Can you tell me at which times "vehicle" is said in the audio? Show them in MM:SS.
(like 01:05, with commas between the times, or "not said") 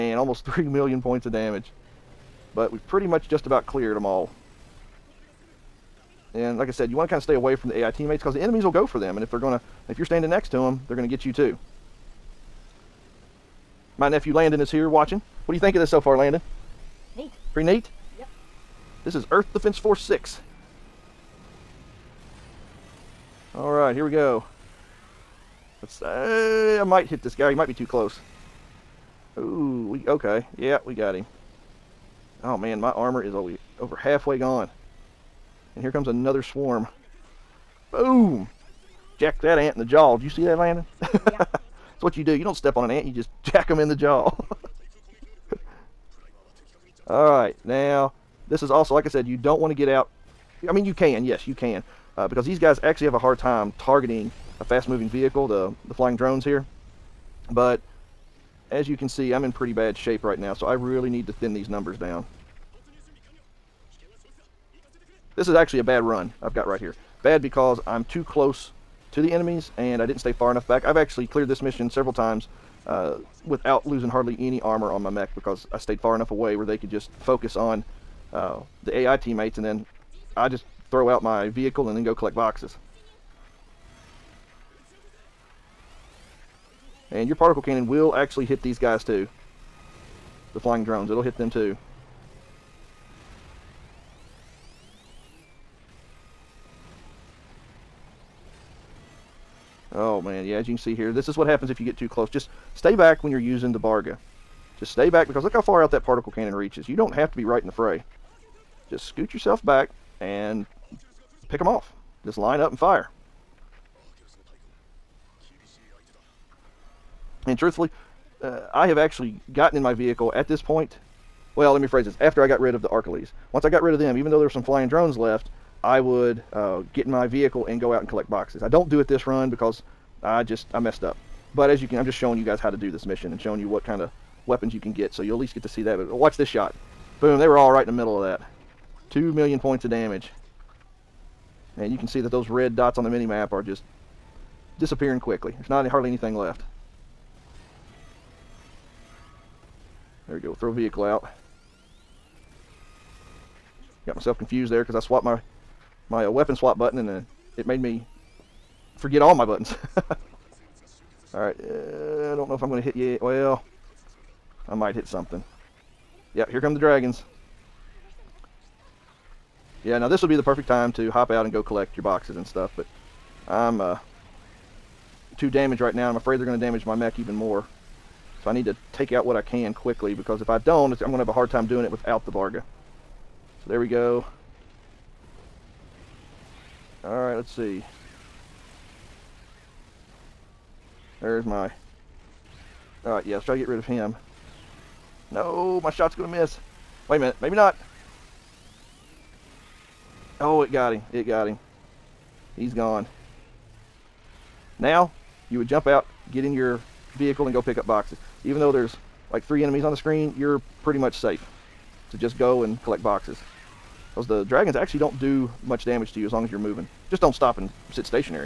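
00:55, 01:21, 01:59, 02:07, 02:30, 03:27.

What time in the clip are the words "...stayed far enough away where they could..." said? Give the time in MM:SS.
01:15.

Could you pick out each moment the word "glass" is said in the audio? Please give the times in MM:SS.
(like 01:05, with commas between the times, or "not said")
not said.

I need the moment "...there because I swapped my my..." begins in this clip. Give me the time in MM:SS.
02:34.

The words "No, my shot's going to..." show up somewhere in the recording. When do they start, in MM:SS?
03:15.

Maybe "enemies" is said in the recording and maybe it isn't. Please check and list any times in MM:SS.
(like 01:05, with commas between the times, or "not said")
00:08, 01:09, 03:29.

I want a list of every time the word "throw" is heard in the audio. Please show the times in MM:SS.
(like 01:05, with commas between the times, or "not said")
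01:20, 02:30.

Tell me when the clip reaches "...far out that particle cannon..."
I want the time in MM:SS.
01:45.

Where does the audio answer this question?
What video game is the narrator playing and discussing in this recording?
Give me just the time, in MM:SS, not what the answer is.
00:19.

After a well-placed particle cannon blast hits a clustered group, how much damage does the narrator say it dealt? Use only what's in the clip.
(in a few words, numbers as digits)
2 million points.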